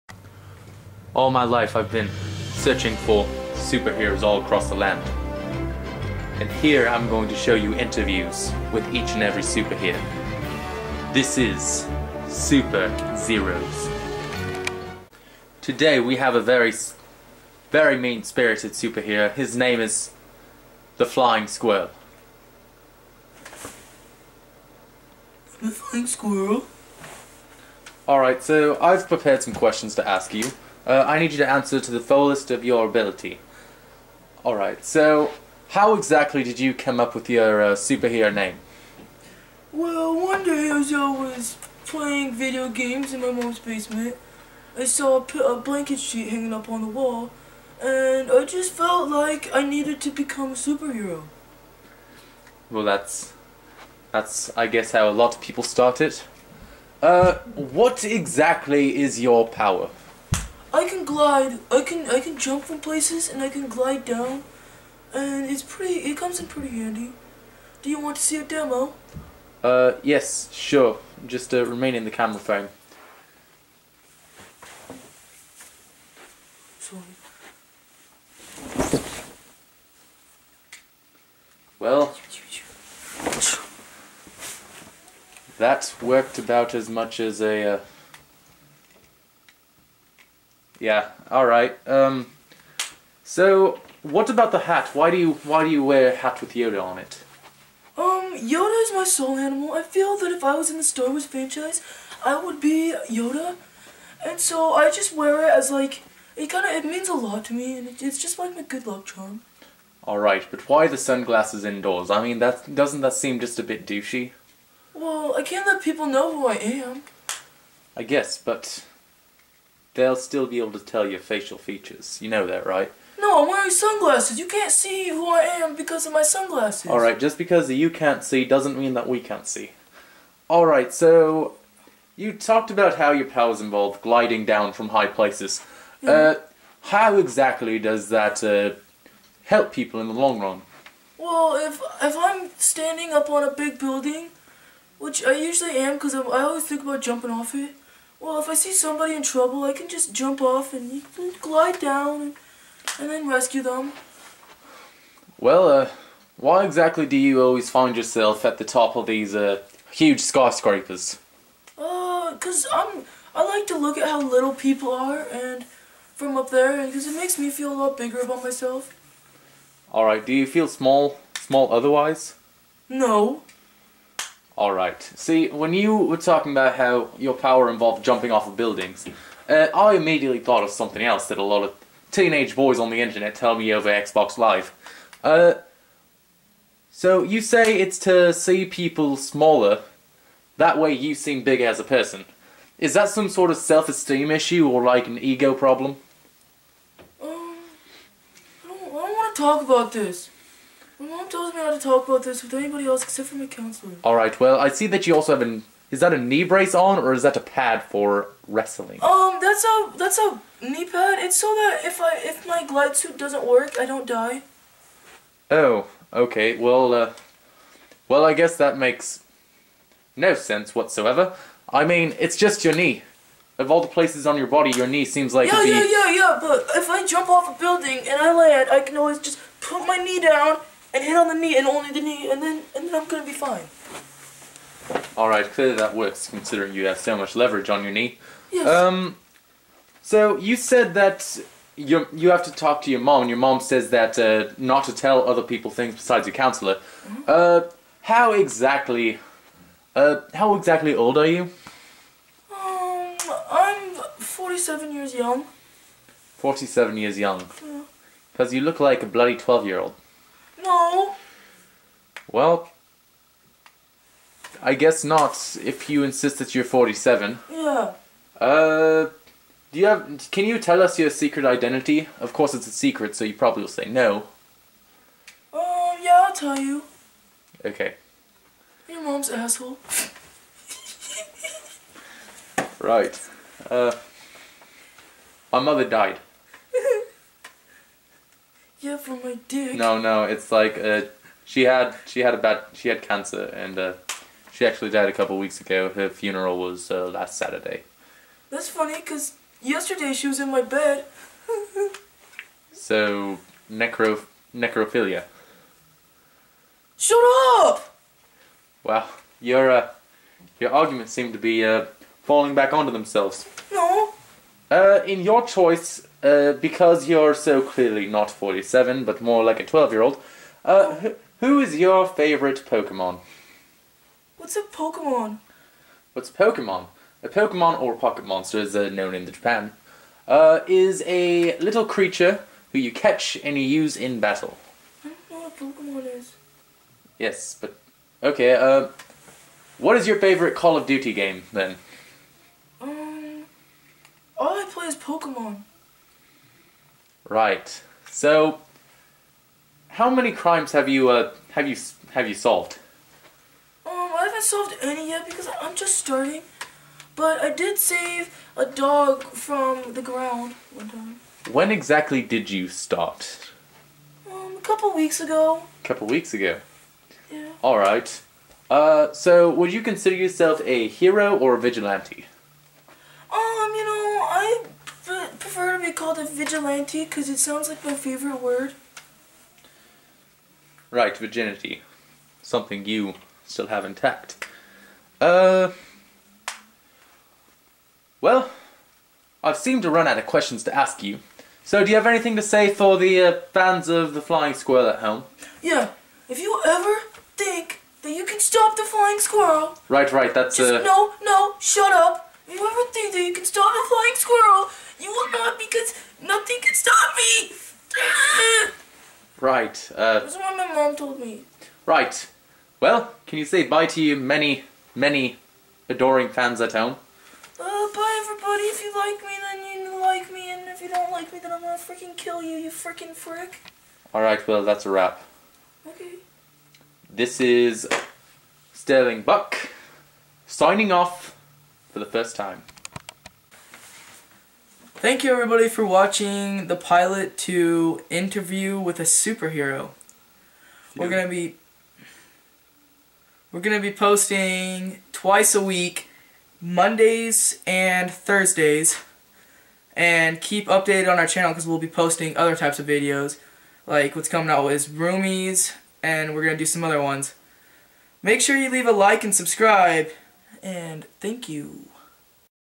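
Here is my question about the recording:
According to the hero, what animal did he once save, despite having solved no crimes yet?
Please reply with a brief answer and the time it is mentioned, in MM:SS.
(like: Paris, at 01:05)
A dog, at 05:58.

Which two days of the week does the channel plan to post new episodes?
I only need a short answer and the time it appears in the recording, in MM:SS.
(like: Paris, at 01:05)
Mondays and Thursdays, at 07:26.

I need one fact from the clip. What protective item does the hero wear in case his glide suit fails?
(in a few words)
Knee pad.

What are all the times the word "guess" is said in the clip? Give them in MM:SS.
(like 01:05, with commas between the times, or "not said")
00:54, 01:58, 03:38, 04:24.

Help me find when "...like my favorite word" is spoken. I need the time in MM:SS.
06:17.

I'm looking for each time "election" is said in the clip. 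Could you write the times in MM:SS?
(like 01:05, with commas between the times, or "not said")
not said.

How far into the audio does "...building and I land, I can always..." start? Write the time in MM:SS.
03:47.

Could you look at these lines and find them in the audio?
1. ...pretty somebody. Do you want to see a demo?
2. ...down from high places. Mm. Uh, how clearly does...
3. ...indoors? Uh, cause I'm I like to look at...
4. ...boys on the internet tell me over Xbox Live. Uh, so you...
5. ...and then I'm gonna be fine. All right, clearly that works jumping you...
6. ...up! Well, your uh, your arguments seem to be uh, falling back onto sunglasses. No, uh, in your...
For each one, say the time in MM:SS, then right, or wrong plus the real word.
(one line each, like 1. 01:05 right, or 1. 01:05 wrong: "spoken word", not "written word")
1. 01:06 wrong: "handy", not "somebody"
2. 02:14 wrong: "exactly", not "clearly"
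3. 02:40 wrong: "skyscrapers", not "indoors"
4. 03:02 right
5. 03:52 wrong: "considering", not "jumping"
6. 05:07 wrong: "themselves", not "sunglasses".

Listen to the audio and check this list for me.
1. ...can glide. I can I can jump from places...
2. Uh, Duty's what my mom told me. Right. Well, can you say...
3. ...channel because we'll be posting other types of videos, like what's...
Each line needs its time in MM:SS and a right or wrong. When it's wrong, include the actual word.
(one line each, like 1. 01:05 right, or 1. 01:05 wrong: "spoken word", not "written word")
1. 01:00 right
2. 06:49 wrong: "That", not "Duty"
3. 07:31 right.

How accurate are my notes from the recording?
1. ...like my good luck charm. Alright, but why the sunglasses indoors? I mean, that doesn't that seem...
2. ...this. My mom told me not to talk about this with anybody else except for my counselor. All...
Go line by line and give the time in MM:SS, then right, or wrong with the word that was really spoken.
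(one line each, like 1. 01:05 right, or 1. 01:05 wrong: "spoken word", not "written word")
1. 01:48 right
2. 03:19 right.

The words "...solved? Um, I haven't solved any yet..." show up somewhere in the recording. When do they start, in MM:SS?
05:52.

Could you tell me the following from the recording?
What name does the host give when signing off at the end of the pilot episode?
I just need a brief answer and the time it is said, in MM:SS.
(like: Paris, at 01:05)
Sterling Buck, at 07:08.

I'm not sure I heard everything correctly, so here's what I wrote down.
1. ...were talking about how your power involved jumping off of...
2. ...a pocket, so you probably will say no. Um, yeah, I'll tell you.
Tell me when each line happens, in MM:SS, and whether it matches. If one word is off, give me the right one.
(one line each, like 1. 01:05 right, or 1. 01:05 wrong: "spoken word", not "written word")
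1. 02:55 right
2. 04:32 wrong: "secret", not "pocket".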